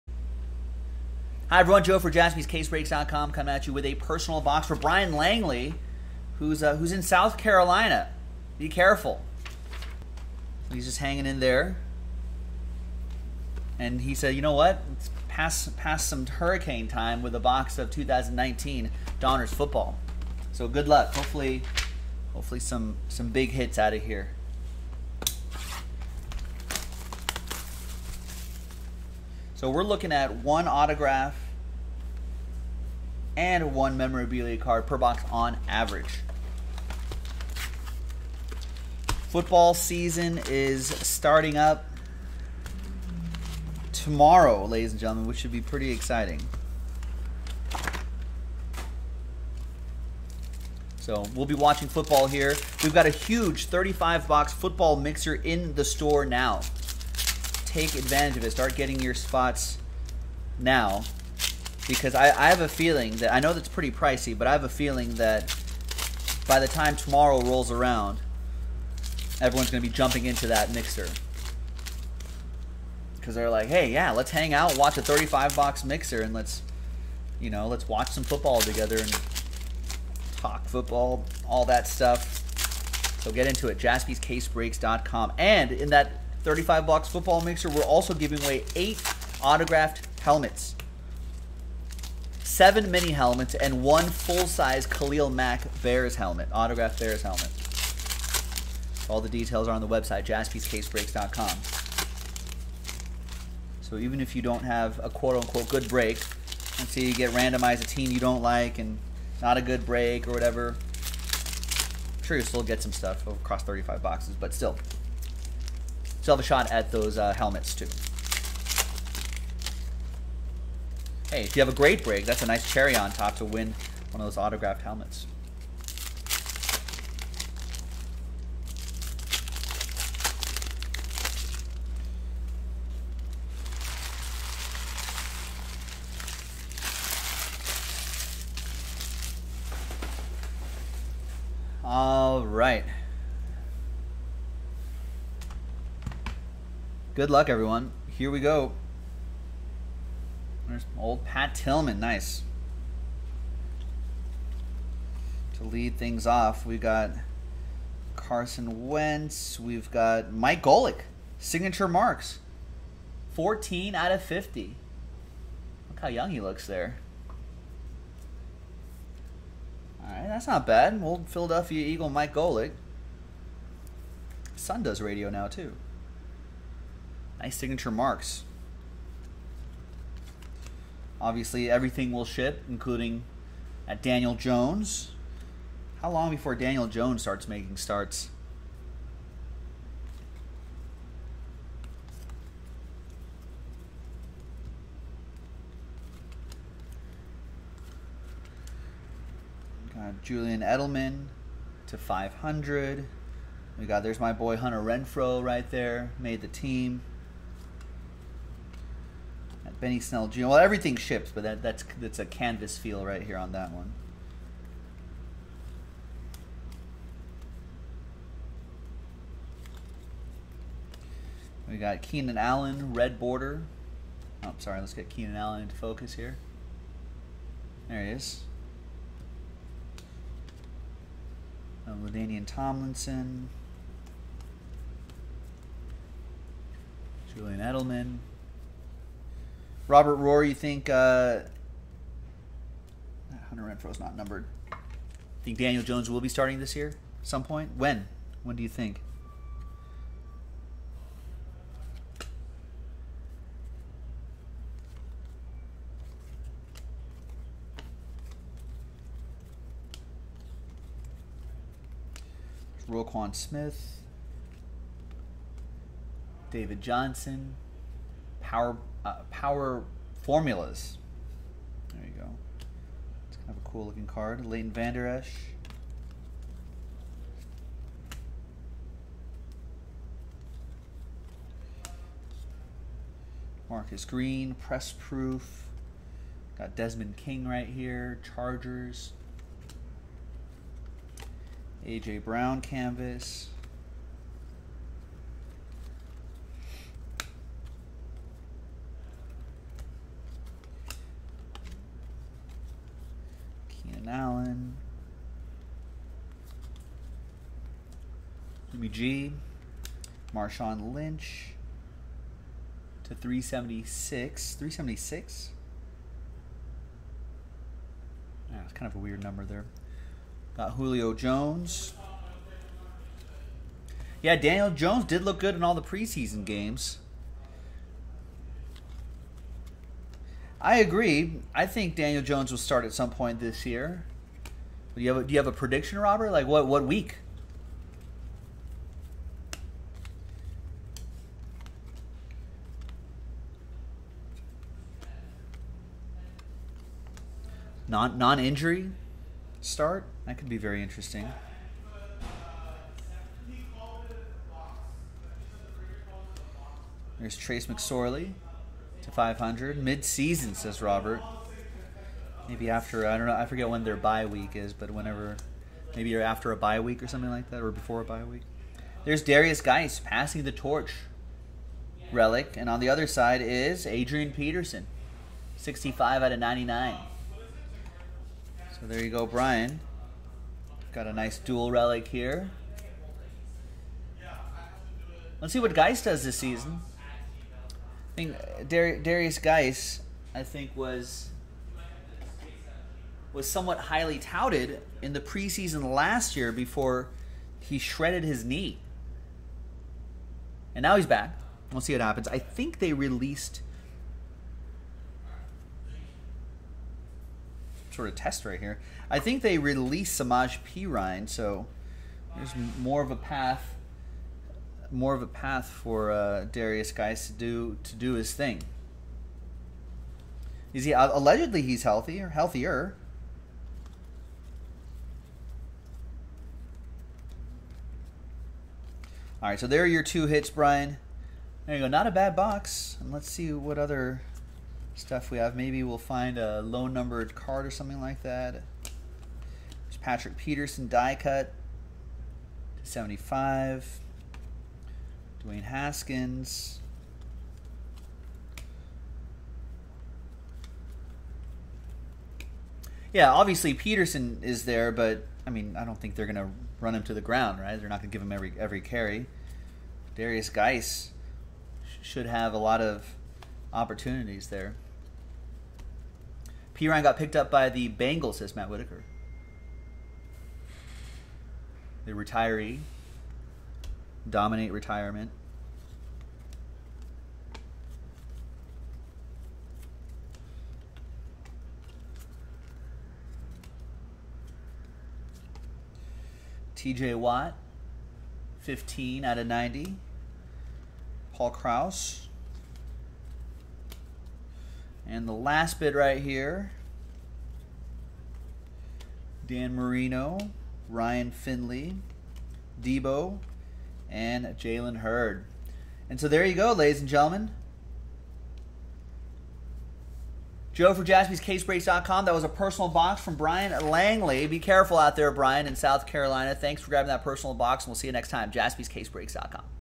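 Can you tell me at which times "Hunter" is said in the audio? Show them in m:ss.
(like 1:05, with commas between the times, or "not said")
3:24, 4:03.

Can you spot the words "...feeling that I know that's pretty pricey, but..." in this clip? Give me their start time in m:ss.
1:02.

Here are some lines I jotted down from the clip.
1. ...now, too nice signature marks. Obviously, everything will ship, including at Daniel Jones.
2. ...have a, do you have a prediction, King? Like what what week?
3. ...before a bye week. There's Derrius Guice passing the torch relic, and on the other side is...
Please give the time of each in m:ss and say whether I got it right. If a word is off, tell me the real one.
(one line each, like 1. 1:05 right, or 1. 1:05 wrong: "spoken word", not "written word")
1. 2:55 right
2. 5:35 wrong: "Robert", not "King"
3. 6:07 right.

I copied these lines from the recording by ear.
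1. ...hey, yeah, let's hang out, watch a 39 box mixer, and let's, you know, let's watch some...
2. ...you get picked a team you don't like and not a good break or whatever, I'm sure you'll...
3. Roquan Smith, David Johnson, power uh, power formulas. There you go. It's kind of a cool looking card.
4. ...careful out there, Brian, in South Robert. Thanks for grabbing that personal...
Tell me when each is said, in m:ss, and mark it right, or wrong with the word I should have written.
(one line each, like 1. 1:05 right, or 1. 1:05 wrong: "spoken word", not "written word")
1. 1:13 wrong: "35", not "39"
2. 1:47 wrong: "randomized", not "picked"
3. 4:22 right
4. 8:34 wrong: "Carolina", not "Robert".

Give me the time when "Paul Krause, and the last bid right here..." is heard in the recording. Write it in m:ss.
8:11.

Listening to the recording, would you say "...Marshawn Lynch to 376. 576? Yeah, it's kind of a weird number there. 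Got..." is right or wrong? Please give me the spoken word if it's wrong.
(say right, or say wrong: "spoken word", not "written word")
wrong: "376", not "576".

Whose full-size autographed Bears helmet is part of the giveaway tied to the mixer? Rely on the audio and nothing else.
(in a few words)
Khalil Mack.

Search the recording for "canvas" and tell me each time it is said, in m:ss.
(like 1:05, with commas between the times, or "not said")
3:32, 4:52.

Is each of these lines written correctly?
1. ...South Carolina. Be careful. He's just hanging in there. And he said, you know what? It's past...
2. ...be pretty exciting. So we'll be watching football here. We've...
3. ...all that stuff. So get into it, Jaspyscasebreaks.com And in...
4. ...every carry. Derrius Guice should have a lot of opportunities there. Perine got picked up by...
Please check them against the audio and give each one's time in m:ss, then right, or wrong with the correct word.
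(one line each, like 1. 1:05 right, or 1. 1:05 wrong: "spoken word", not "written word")
1. 0:07 right
2. 0:45 right
3. 1:21 right
4. 7:38 right.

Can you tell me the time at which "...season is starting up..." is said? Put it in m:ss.
0:39.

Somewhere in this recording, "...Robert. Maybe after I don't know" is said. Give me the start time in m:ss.
6:00.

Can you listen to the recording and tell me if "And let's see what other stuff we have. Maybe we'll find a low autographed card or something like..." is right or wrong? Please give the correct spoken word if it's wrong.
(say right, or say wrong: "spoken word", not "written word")
wrong: "numbered", not "autographed".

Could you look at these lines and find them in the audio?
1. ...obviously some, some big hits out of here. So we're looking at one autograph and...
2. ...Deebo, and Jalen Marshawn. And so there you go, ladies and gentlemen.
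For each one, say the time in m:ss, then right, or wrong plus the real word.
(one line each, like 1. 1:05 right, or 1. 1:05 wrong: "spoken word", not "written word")
1. 0:22 wrong: "hopefully", not "obviously"
2. 8:22 wrong: "Hurd", not "Marshawn".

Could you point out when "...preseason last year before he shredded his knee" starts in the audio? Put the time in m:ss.
6:35.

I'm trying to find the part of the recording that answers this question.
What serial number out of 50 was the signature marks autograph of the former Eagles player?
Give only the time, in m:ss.
2:43.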